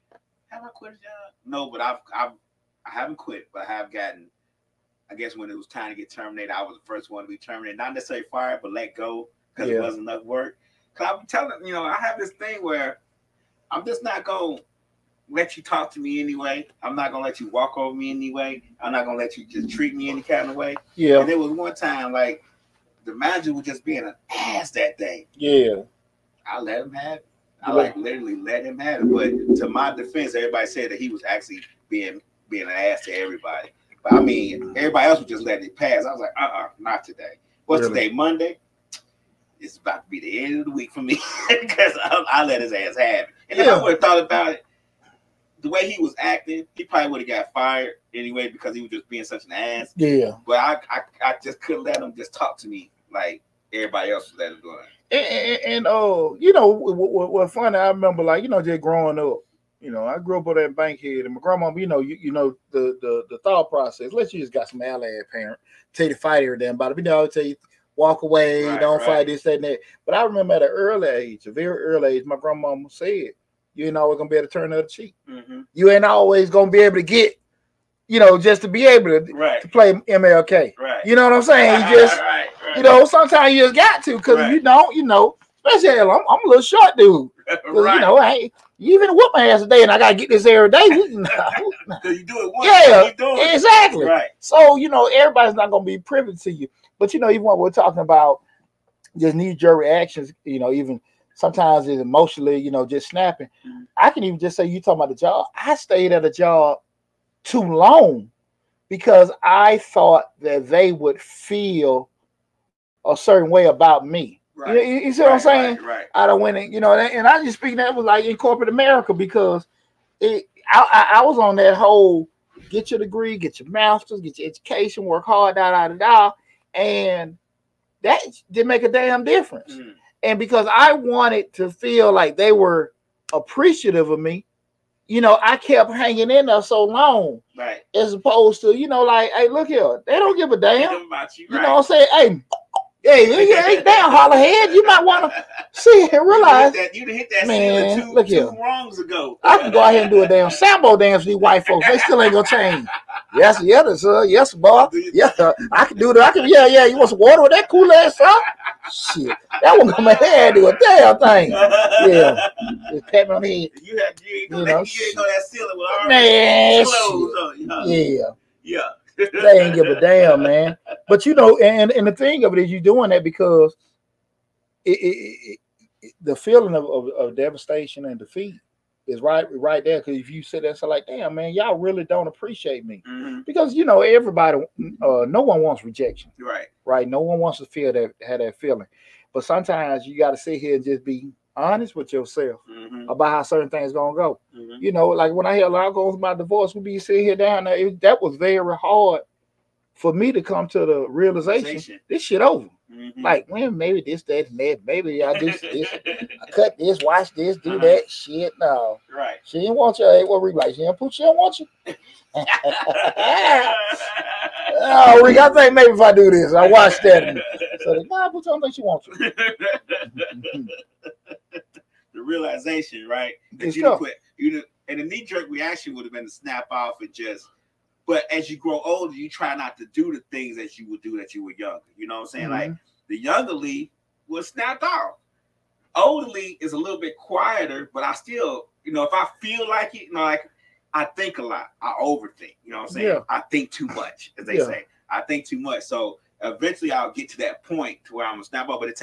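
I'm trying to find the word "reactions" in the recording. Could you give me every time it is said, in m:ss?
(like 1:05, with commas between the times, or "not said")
1:39, 3:45.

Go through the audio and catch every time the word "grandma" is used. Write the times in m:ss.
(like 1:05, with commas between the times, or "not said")
1:01, 1:12.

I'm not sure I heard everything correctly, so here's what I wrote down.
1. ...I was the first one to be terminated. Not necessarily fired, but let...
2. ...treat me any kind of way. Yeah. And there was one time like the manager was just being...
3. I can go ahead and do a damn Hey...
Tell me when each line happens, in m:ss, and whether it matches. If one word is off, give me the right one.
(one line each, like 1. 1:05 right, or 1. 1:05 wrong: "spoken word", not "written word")
1. 0:06 right
2. 0:19 right
3. 2:29 wrong: "Sambo", not "Hey".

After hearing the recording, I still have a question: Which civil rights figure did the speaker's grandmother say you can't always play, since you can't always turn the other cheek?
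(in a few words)
MLK.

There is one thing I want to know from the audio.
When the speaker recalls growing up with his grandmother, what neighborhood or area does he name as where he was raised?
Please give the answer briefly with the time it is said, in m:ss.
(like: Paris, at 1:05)
Bankhead, at 1:00.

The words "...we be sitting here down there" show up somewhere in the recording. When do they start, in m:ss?
3:16.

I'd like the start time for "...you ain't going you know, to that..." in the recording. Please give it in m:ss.
2:44.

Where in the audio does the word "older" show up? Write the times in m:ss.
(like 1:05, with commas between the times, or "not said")
3:48, 3:55.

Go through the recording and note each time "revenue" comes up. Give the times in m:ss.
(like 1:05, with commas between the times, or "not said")
not said.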